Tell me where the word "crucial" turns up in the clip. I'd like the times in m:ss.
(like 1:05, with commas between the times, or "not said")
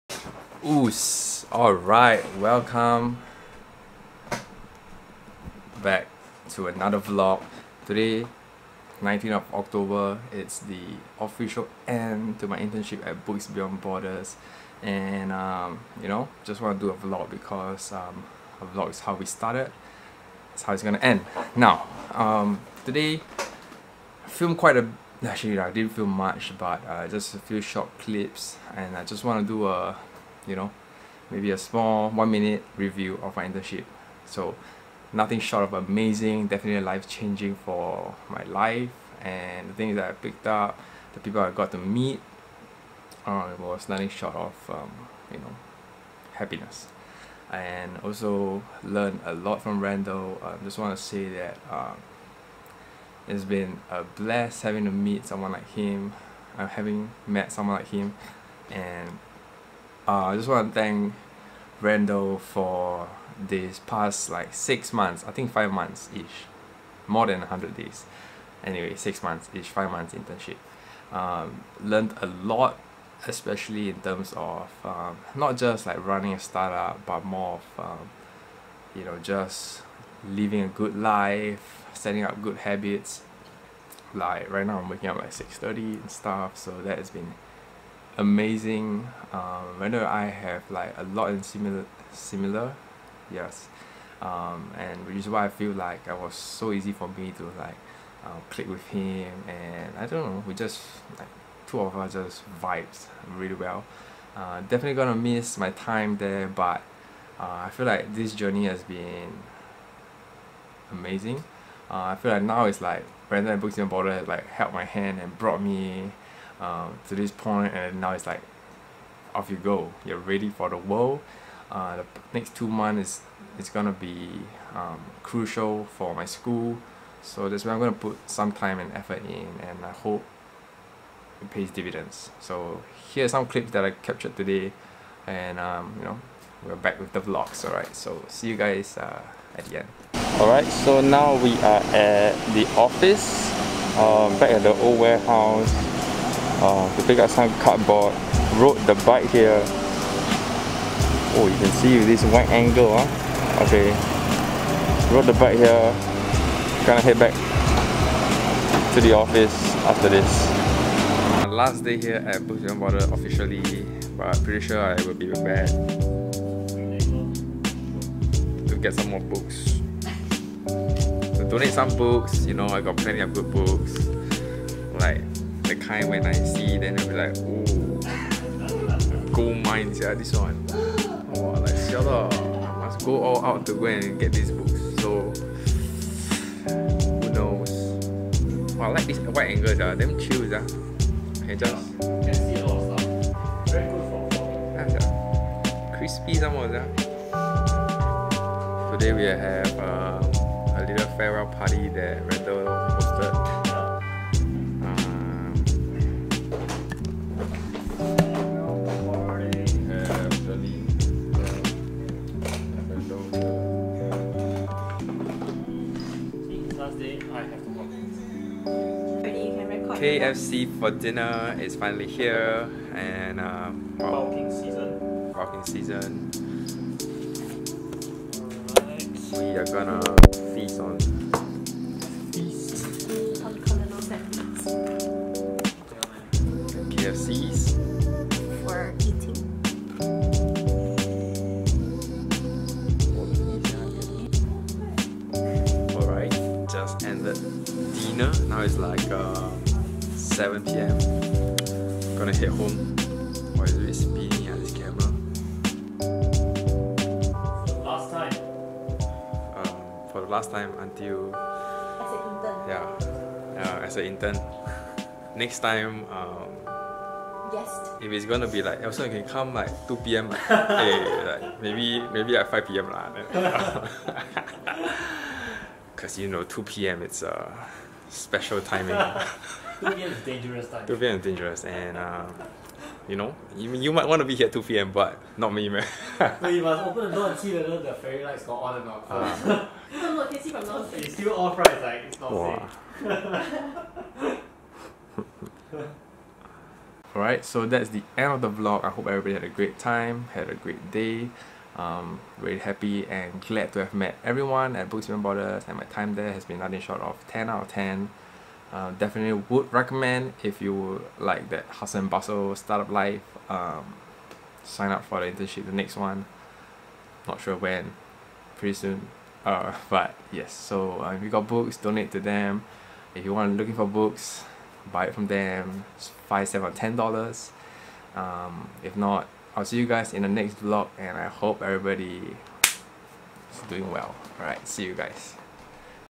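2:05.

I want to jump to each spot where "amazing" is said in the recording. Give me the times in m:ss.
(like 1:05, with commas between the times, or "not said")
0:35, 1:28, 1:50.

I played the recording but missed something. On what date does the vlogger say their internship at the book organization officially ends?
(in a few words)
19th of October.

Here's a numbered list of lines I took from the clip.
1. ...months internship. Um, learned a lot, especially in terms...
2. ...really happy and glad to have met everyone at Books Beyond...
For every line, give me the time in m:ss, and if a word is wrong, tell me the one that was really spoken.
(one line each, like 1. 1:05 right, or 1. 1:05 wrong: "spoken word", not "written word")
1. 1:09 right
2. 5:02 wrong: "Borders", not "Beyond".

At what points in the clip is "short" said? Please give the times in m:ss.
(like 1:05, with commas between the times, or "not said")
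0:27, 0:35, 0:44, 5:06.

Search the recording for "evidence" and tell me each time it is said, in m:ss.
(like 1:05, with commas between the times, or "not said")
not said.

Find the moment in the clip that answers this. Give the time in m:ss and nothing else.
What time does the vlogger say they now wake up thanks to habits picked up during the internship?
1:25.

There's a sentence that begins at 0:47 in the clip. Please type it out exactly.
And also learned a lot from Randall.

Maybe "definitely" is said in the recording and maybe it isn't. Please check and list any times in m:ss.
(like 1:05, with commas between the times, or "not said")
0:36, 1:44, 5:08.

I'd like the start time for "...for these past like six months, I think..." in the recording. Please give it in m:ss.
1:02.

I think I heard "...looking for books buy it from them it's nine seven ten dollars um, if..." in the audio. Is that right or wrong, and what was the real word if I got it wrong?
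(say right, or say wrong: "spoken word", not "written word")
wrong: "five", not "nine".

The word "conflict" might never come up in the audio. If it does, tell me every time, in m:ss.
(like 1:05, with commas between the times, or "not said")
not said.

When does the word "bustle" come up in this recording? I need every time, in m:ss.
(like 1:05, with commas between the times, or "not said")
5:12.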